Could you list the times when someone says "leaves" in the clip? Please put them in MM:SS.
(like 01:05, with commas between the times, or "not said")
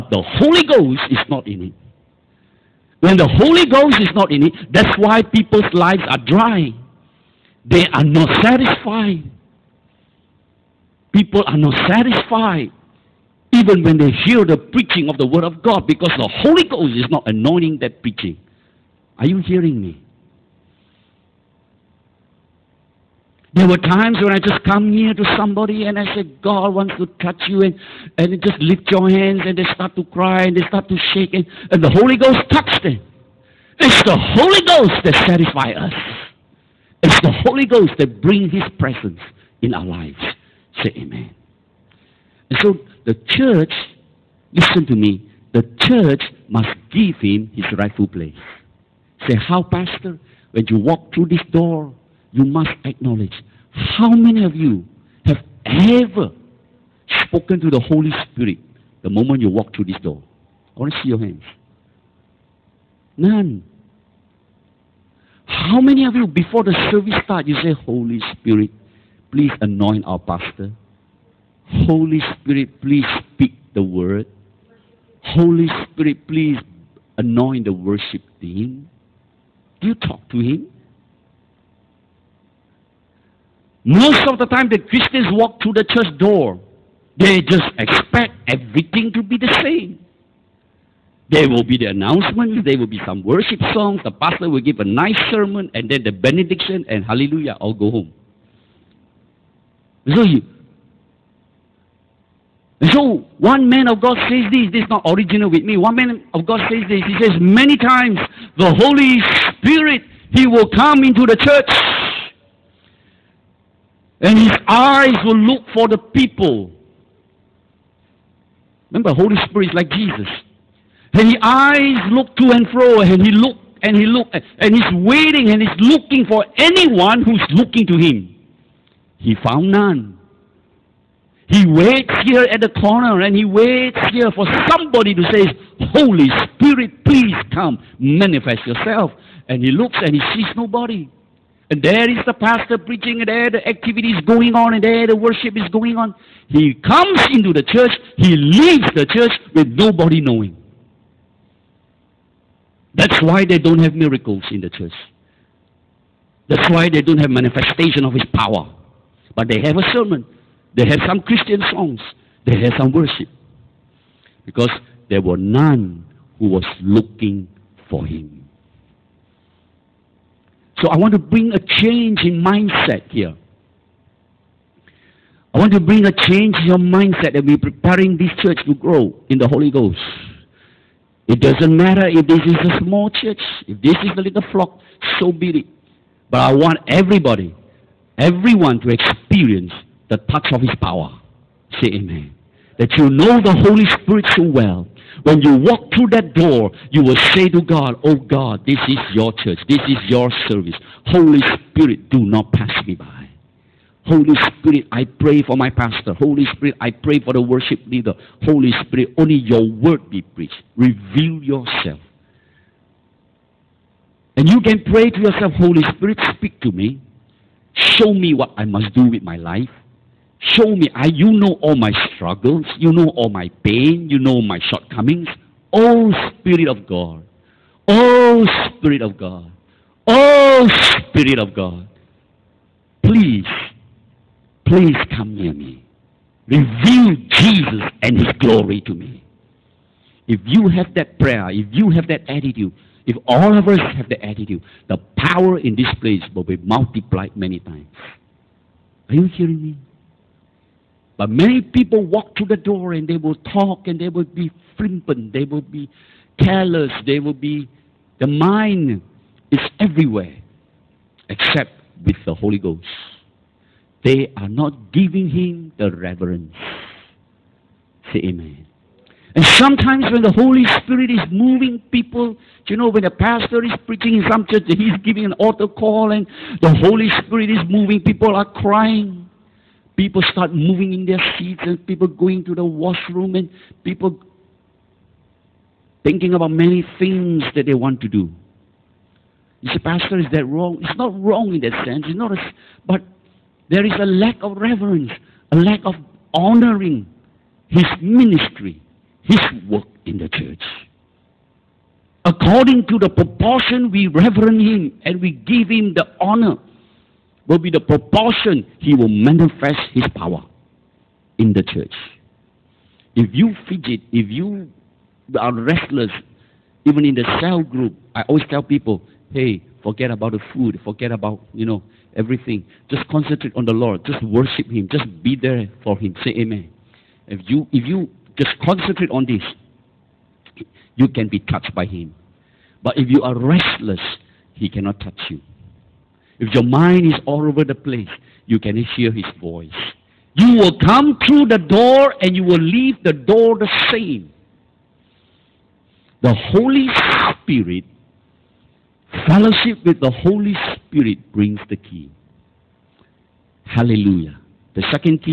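02:28, 05:42.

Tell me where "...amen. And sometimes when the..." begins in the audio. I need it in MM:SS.
04:28.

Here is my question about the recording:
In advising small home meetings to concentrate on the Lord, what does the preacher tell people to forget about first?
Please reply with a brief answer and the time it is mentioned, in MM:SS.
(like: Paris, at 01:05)
The food, at 05:20.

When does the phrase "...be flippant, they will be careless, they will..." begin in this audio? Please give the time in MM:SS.
04:14.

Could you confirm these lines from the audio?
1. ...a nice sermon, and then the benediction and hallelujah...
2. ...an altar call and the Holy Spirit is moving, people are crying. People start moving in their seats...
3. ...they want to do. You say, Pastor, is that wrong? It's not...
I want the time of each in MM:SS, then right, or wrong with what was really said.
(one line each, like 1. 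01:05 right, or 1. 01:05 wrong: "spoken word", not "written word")
1. 01:34 right
2. 04:35 right
3. 04:47 right.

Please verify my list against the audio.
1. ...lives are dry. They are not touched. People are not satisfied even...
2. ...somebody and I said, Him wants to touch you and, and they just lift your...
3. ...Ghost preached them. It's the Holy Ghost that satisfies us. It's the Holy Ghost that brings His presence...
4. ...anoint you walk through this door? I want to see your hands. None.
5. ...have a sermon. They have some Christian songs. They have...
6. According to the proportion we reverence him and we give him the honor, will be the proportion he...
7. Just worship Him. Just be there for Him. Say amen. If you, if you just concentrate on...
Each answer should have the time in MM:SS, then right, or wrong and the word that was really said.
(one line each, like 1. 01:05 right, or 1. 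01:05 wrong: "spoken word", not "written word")
1. 00:05 wrong: "satisfied", not "touched"
2. 00:25 wrong: "God", not "Him"
3. 00:32 wrong: "touched", not "preached"
4. 00:59 wrong: "moment", not "anoint"
5. 02:39 right
6. 05:02 right
7. 05:24 right.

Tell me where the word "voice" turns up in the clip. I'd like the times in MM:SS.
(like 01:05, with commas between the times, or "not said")
05:39.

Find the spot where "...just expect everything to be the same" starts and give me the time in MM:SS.
01:27.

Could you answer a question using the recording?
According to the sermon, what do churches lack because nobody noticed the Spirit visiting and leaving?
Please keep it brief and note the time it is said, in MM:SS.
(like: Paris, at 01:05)
Miracles, at 02:33.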